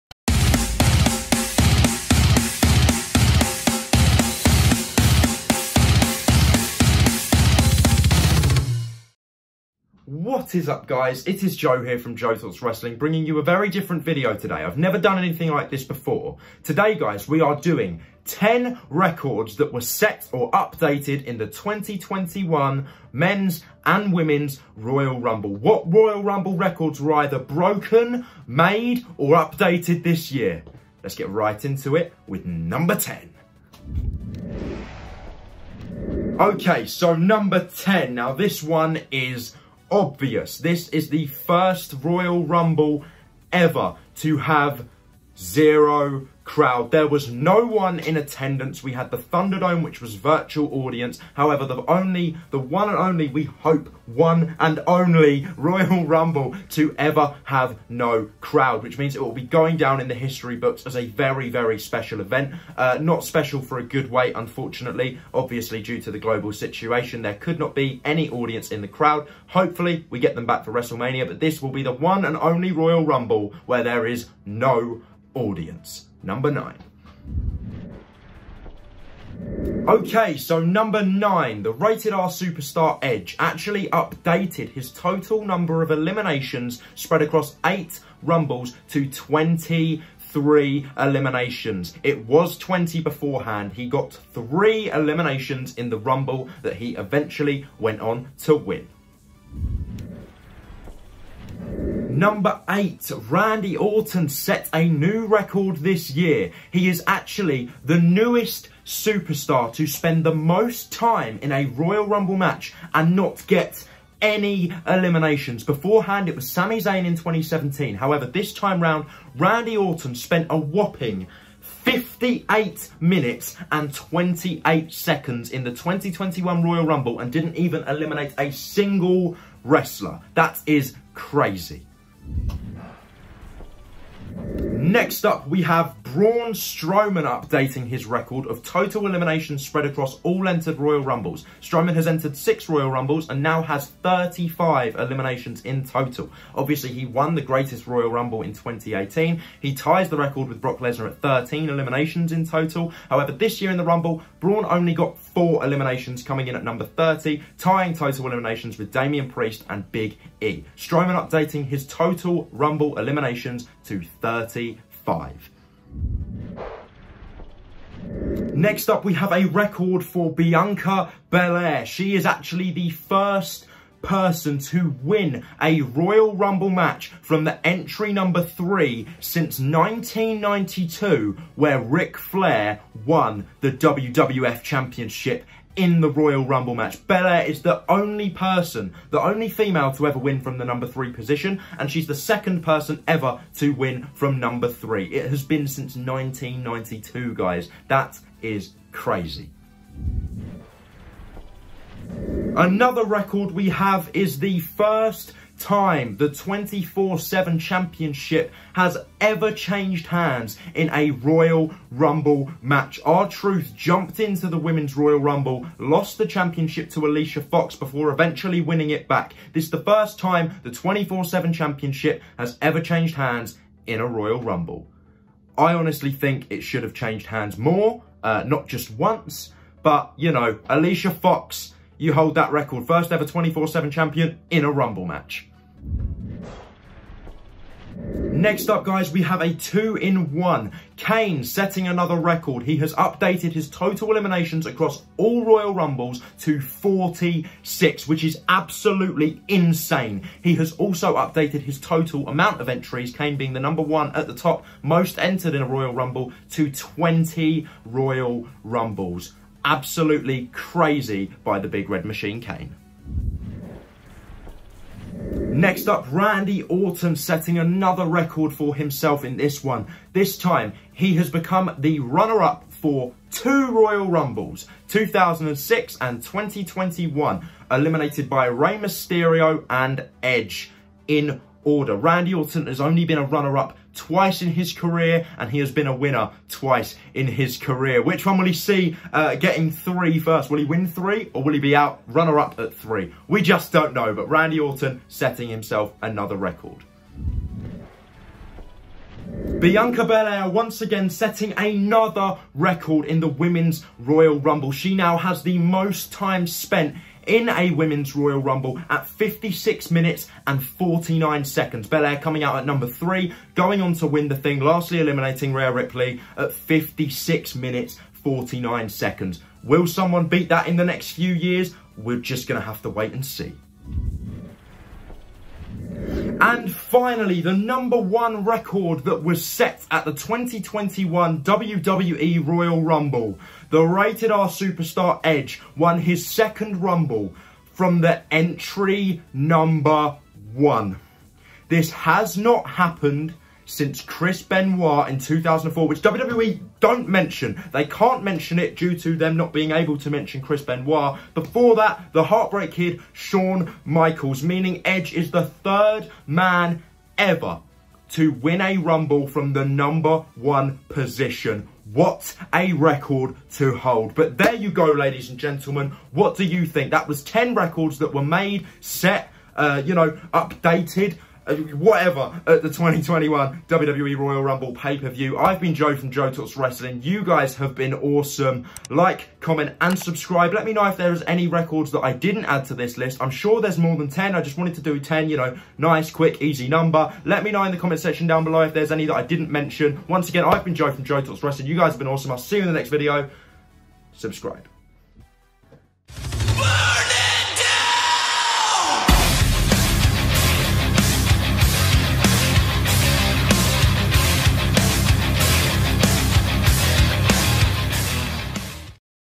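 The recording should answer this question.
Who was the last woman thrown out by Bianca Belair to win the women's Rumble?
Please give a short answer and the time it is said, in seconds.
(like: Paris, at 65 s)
Rhea Ripley, at 315 s.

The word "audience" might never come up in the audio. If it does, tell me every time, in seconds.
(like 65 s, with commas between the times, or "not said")
50 s, 68 s, 75 s.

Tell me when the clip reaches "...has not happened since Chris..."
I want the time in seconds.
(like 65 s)
341 s.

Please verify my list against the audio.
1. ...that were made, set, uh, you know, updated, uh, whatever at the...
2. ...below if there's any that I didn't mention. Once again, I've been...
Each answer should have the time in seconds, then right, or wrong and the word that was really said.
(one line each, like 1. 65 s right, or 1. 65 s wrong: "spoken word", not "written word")
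1. 367 s right
2. 388 s right.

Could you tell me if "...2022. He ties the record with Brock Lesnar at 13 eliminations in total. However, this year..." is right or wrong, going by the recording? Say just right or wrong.
wrong.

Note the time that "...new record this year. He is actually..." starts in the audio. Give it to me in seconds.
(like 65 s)
104 s.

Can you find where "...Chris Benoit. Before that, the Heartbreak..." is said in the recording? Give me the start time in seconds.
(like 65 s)
350 s.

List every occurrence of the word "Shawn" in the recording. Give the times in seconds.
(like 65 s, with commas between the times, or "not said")
353 s.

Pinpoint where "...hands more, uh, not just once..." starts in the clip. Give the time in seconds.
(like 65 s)
227 s.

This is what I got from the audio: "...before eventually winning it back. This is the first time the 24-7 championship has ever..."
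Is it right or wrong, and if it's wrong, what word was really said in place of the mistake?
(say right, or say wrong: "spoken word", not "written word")
right.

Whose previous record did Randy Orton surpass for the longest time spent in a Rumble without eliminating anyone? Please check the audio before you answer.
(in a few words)
Sami Zayn.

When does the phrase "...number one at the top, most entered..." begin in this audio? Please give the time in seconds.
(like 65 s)
253 s.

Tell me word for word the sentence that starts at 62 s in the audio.
Uh, not special for a good way, unfortunately.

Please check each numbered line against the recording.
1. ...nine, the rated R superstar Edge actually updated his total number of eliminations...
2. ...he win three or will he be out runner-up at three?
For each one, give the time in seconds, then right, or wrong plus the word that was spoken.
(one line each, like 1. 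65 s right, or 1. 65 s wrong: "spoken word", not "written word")
1. 81 s right
2. 290 s right.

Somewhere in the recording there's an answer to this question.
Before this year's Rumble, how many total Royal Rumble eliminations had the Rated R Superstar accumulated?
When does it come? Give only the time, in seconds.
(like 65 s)
92 s.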